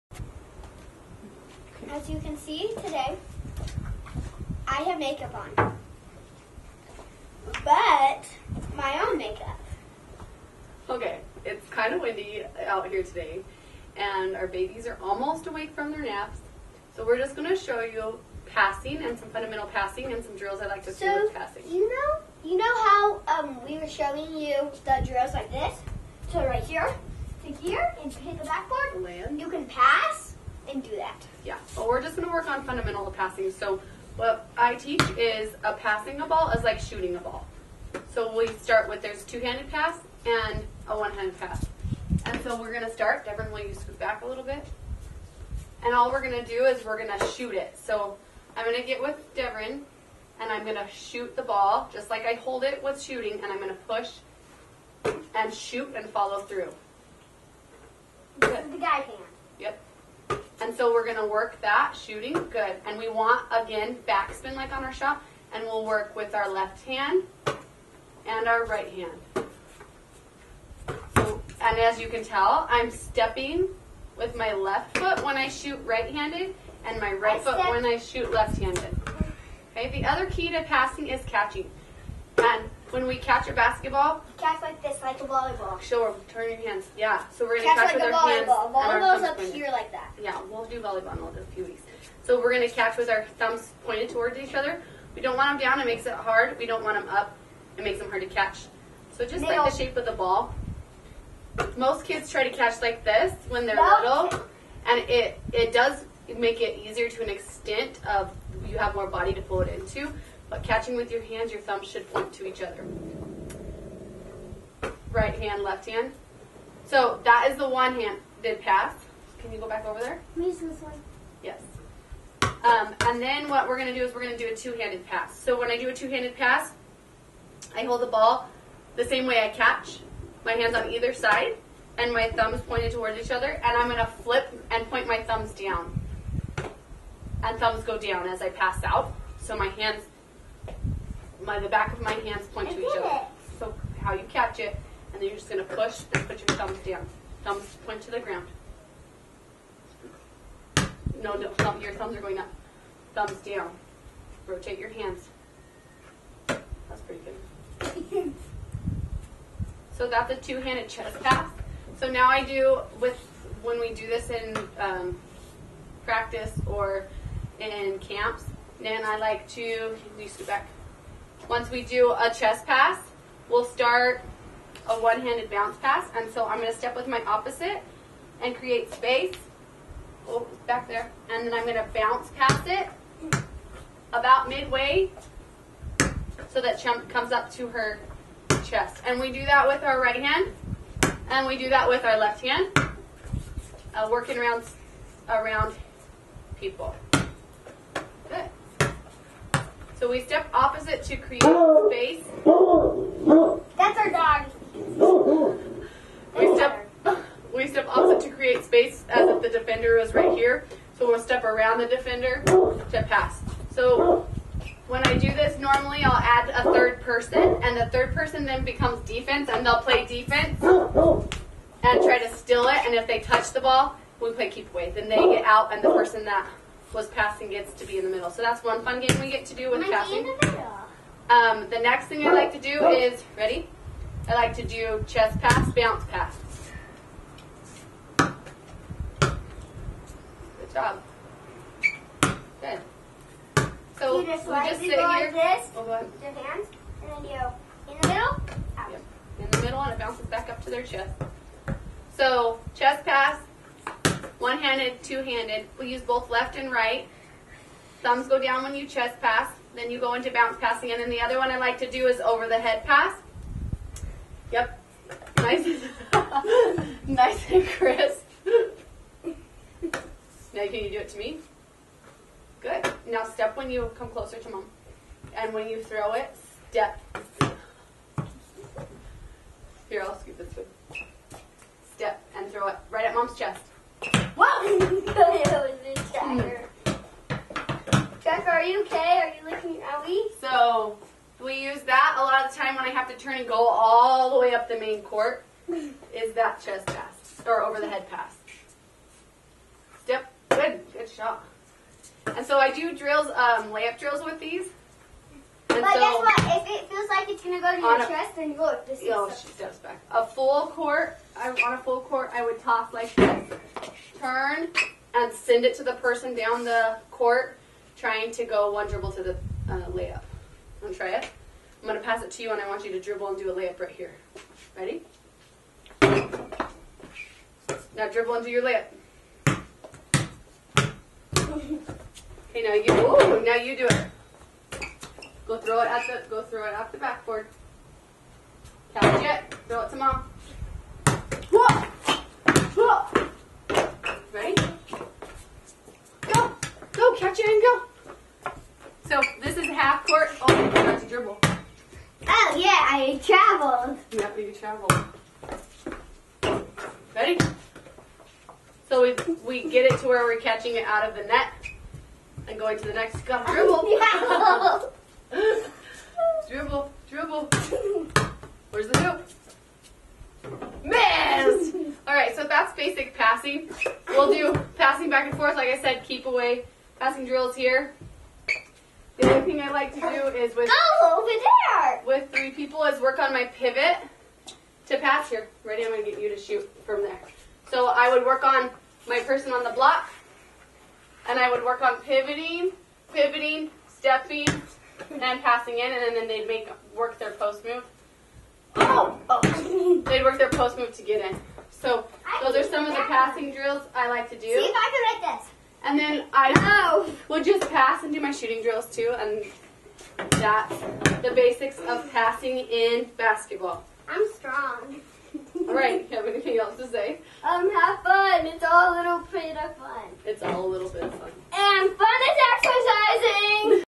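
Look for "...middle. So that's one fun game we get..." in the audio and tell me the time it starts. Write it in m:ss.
3:48.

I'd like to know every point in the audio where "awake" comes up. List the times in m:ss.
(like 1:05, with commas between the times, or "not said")
0:15.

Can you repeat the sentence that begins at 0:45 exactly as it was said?
And all we're going to do is we're going to shoot it.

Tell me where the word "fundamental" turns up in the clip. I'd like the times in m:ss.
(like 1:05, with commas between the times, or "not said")
0:19, 0:32.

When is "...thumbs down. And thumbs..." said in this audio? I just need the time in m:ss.
2:15.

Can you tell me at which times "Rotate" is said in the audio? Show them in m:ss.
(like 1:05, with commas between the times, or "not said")
2:34.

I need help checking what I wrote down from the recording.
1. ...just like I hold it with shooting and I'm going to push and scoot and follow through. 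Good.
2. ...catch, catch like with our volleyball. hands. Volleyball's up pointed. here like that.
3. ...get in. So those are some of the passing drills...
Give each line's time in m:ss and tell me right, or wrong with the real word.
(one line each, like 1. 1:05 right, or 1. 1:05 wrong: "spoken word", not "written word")
1. 0:51 wrong: "shoot", not "scoot"
2. 1:27 right
3. 6:41 right.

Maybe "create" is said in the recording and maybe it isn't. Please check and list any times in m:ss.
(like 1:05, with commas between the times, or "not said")
2:58, 3:21, 3:28.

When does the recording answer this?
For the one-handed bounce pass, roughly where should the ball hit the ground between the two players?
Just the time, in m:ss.
3:04.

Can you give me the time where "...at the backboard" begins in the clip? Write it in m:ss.
5:36.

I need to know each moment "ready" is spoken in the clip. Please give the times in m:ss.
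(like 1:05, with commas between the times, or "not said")
3:53, 5:24, 5:57, 6:25.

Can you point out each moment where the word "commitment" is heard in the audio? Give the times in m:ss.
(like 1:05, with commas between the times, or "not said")
not said.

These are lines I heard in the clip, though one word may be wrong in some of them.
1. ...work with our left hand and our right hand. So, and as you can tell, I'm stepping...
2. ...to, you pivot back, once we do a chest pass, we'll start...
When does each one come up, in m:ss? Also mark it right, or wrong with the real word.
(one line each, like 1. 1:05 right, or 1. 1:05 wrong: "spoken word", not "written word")
1. 1:05 right
2. 2:49 wrong: "scoot", not "pivot".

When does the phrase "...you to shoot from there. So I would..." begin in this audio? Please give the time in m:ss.
6:26.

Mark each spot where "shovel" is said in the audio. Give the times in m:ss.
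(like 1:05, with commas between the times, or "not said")
5:54.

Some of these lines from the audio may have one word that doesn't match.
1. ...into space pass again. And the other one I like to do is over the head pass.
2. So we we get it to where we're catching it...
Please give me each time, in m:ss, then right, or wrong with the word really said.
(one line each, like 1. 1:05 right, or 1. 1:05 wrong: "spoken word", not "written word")
1. 4:20 wrong: "bounce", not "space"
2. 5:58 right.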